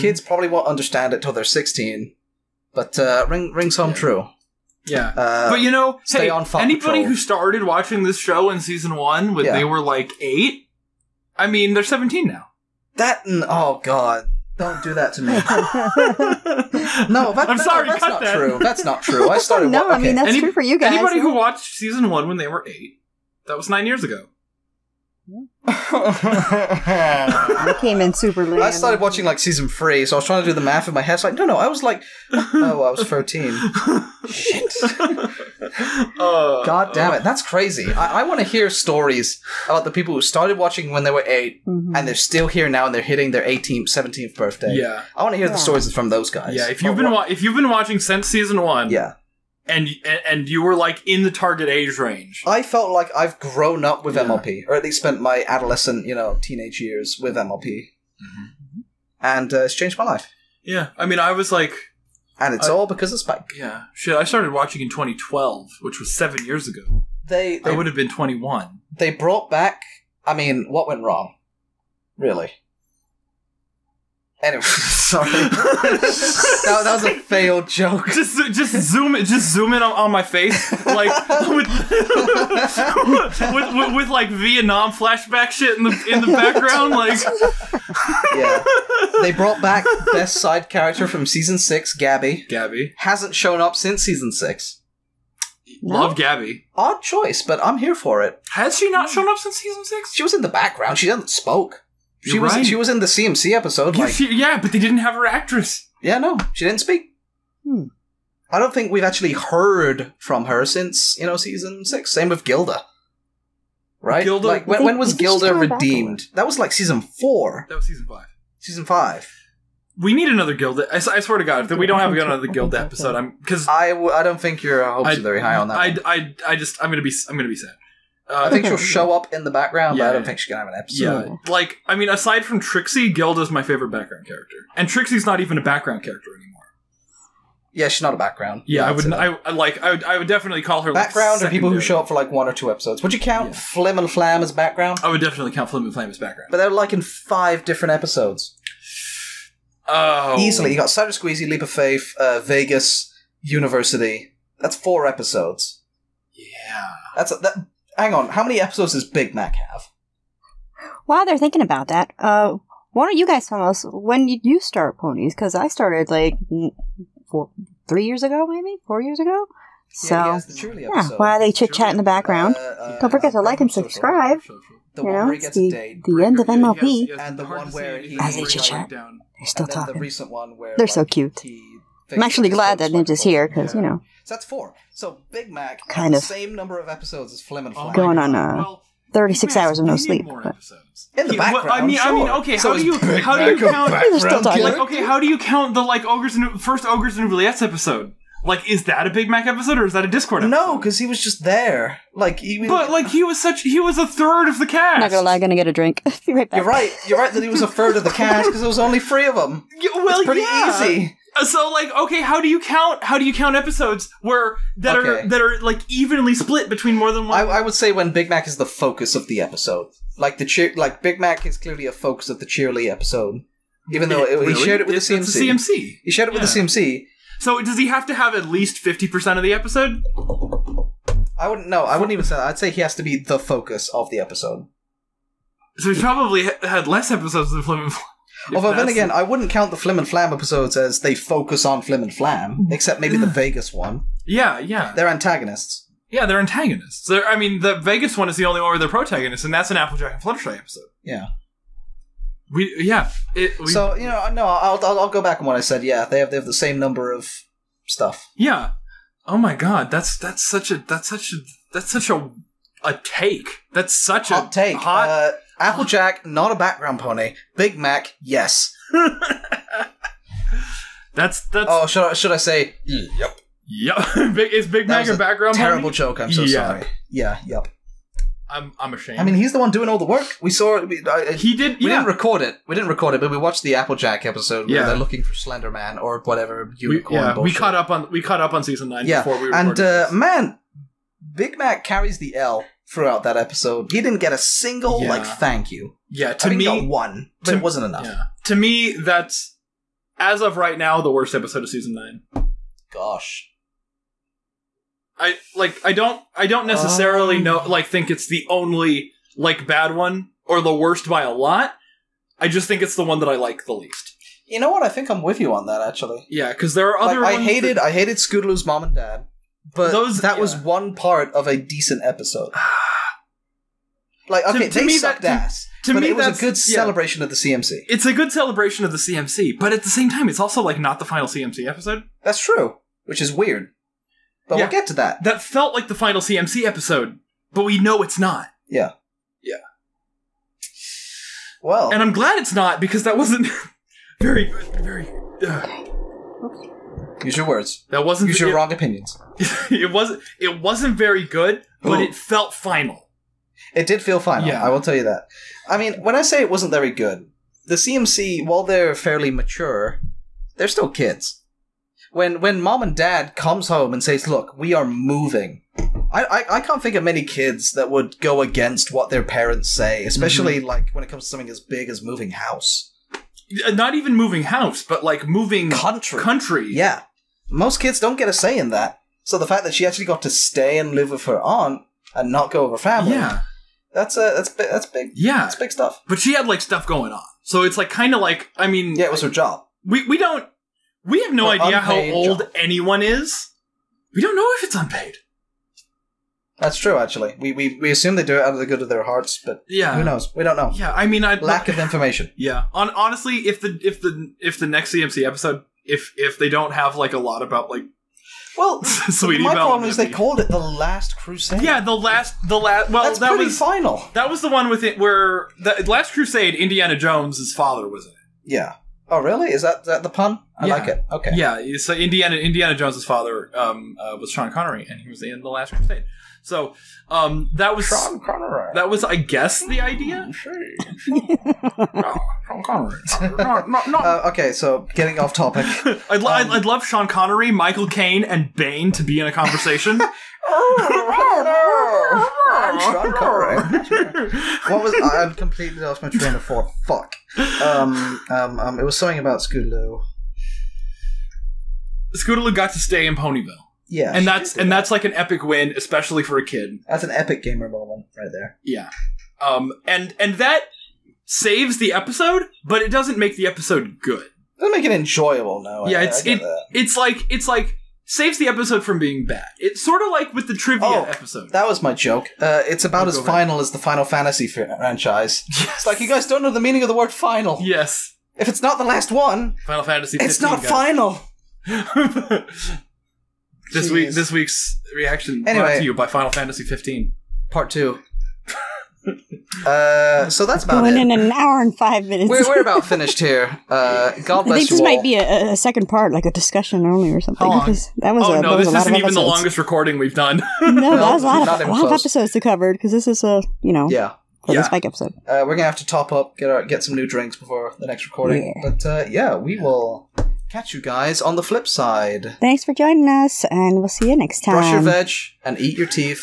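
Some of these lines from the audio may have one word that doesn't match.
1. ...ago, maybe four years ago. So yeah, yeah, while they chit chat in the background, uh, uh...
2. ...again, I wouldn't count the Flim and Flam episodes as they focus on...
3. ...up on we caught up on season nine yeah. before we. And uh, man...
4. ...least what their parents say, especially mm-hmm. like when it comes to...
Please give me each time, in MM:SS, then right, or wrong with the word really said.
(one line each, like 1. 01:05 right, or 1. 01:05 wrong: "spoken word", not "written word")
1. 02:48 right
2. 03:58 right
3. 04:47 right
4. 06:08 wrong: "against", not "least".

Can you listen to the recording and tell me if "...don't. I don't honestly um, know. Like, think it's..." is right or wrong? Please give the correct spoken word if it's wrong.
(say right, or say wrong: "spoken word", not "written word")
wrong: "necessarily", not "honestly".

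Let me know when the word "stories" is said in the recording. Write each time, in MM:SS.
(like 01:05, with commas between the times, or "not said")
00:38, 00:45.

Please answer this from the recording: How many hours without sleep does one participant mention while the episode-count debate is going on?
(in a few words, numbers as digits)
36.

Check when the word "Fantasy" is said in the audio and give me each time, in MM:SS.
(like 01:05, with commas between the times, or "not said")
07:54, 07:59, 08:06.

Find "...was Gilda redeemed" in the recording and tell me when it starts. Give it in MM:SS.
01:54.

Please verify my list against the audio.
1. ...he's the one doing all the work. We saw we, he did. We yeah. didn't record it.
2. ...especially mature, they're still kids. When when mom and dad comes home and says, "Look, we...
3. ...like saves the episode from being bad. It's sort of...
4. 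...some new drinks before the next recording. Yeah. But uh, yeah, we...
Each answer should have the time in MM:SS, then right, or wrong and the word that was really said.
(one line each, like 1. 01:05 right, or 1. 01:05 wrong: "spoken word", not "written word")
1. 04:39 right
2. 05:58 wrong: "fairly", not "especially"
3. 07:47 right
4. 08:26 right.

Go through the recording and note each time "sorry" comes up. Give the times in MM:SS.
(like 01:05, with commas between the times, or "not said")
00:17, 01:15, 04:36.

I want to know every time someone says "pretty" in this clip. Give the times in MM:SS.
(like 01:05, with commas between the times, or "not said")
03:30, 06:53.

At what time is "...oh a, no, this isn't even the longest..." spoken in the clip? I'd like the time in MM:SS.
08:18.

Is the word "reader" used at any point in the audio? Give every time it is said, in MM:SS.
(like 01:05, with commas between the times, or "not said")
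not said.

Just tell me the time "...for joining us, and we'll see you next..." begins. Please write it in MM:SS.
08:32.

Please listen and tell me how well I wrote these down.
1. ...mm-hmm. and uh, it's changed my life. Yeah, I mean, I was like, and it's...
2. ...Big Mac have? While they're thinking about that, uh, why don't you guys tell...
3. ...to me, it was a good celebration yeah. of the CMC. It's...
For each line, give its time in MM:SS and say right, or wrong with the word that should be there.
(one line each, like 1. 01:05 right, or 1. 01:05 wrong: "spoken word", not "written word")
1. 00:57 right
2. 02:39 right
3. 05:25 right.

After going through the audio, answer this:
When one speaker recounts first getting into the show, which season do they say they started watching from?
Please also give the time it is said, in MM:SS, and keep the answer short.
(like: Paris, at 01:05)
Season 3, at 00:29.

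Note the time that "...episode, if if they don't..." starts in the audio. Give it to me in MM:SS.
06:45.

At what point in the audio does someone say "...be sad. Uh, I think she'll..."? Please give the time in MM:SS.
02:07.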